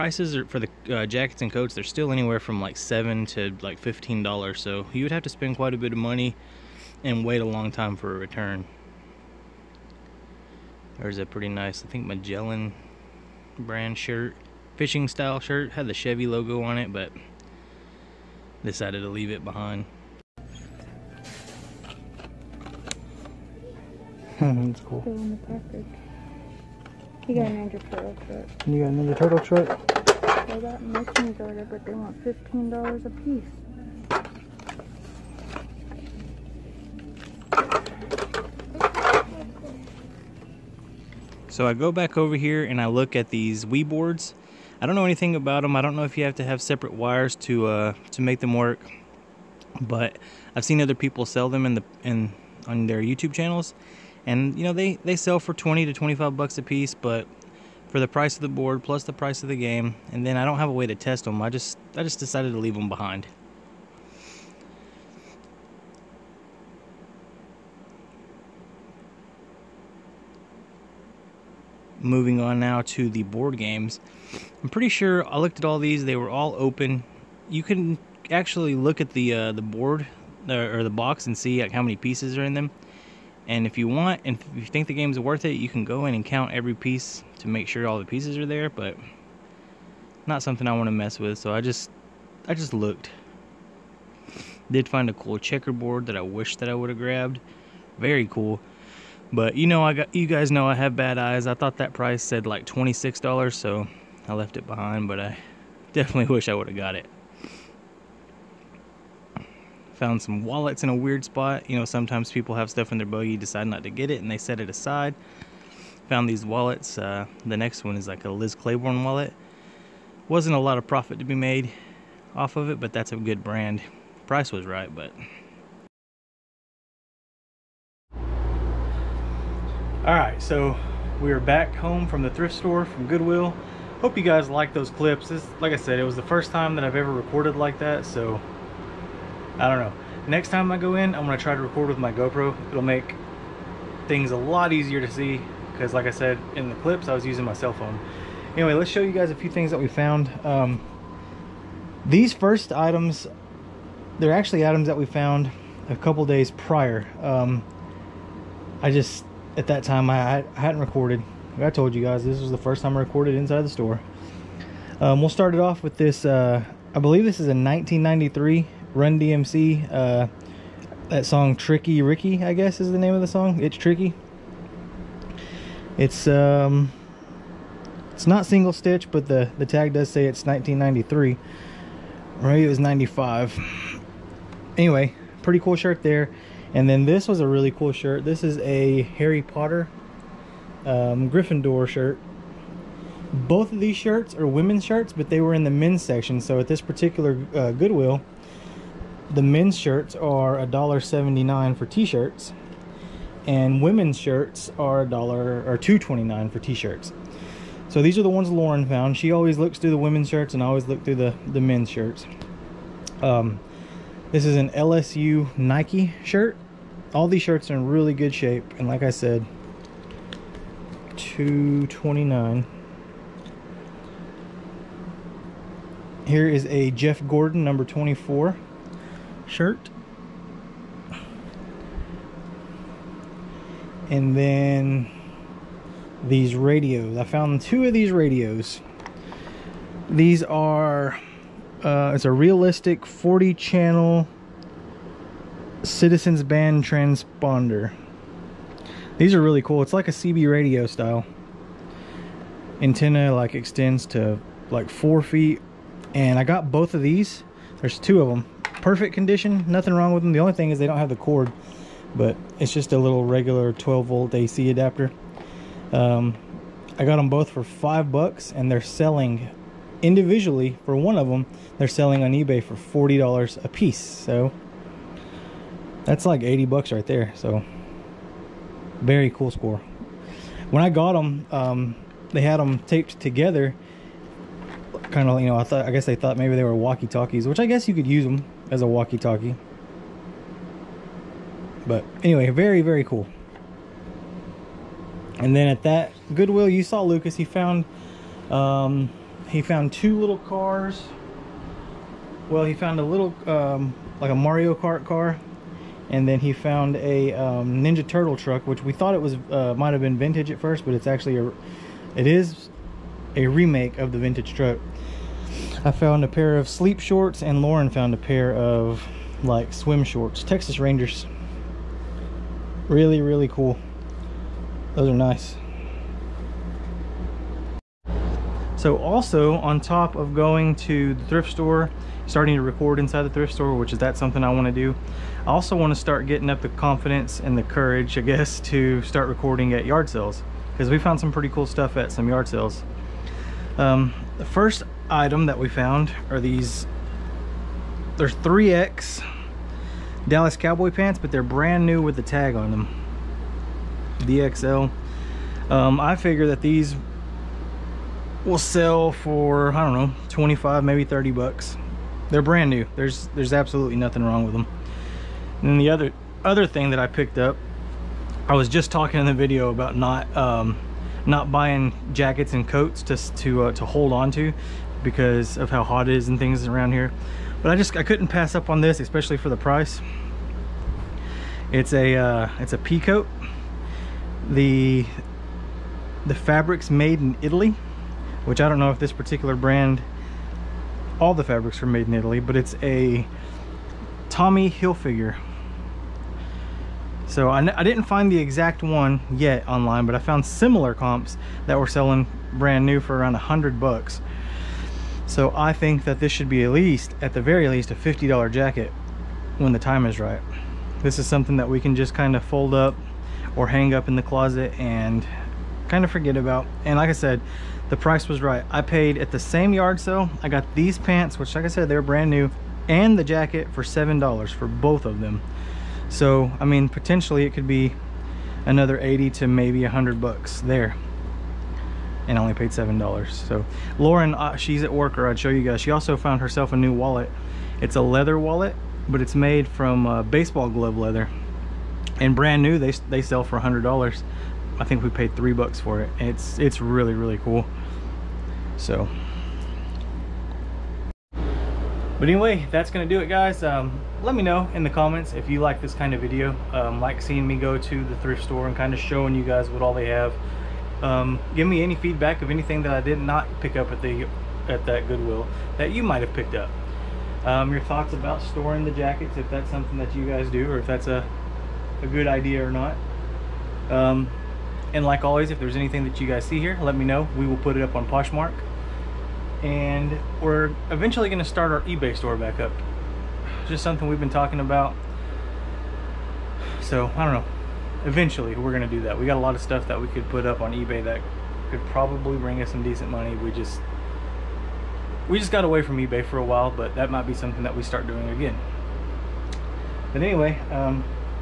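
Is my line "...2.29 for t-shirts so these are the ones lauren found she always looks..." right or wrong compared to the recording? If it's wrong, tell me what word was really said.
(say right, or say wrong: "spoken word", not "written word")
right.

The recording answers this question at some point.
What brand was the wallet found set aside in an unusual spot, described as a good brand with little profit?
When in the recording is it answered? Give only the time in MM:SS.
01:58.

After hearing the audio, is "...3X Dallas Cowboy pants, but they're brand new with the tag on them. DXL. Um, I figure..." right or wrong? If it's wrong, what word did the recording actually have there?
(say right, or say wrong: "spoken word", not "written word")
right.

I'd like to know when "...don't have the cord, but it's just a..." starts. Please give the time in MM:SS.
04:20.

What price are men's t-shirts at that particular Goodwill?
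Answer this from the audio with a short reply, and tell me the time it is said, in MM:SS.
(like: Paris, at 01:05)
$1.79, at 03:20.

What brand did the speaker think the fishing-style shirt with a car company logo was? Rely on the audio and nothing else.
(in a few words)
Magellan.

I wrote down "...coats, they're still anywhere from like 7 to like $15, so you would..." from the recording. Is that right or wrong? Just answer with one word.
right.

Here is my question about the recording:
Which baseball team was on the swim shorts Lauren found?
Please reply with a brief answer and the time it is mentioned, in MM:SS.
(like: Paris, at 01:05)
Texas Rangers, at 05:20.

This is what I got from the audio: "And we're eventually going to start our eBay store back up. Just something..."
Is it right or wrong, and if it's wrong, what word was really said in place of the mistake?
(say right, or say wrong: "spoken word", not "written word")
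right.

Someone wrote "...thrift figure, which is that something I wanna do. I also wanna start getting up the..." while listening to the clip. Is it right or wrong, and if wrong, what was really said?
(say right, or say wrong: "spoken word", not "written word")
wrong: "store", not "figure".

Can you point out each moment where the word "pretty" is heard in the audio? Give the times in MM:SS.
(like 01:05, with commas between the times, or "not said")
00:11, 01:14, 03:05, 05:41.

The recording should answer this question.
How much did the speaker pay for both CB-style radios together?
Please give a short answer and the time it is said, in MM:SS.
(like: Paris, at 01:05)
$5, at 04:27.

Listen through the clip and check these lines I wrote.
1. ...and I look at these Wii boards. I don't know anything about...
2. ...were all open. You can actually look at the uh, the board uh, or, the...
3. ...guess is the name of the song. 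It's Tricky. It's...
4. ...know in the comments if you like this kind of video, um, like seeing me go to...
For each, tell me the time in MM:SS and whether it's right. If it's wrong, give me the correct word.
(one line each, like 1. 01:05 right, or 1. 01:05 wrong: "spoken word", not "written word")
1. 00:42 right
2. 01:16 right
3. 02:52 right
4. 07:34 right.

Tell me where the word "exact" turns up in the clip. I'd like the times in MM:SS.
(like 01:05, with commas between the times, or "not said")
06:38.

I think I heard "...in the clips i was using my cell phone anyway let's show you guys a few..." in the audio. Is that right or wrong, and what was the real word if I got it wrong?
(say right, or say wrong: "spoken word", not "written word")
right.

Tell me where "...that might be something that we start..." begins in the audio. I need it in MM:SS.
08:16.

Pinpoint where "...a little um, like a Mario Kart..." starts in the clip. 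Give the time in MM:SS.
05:03.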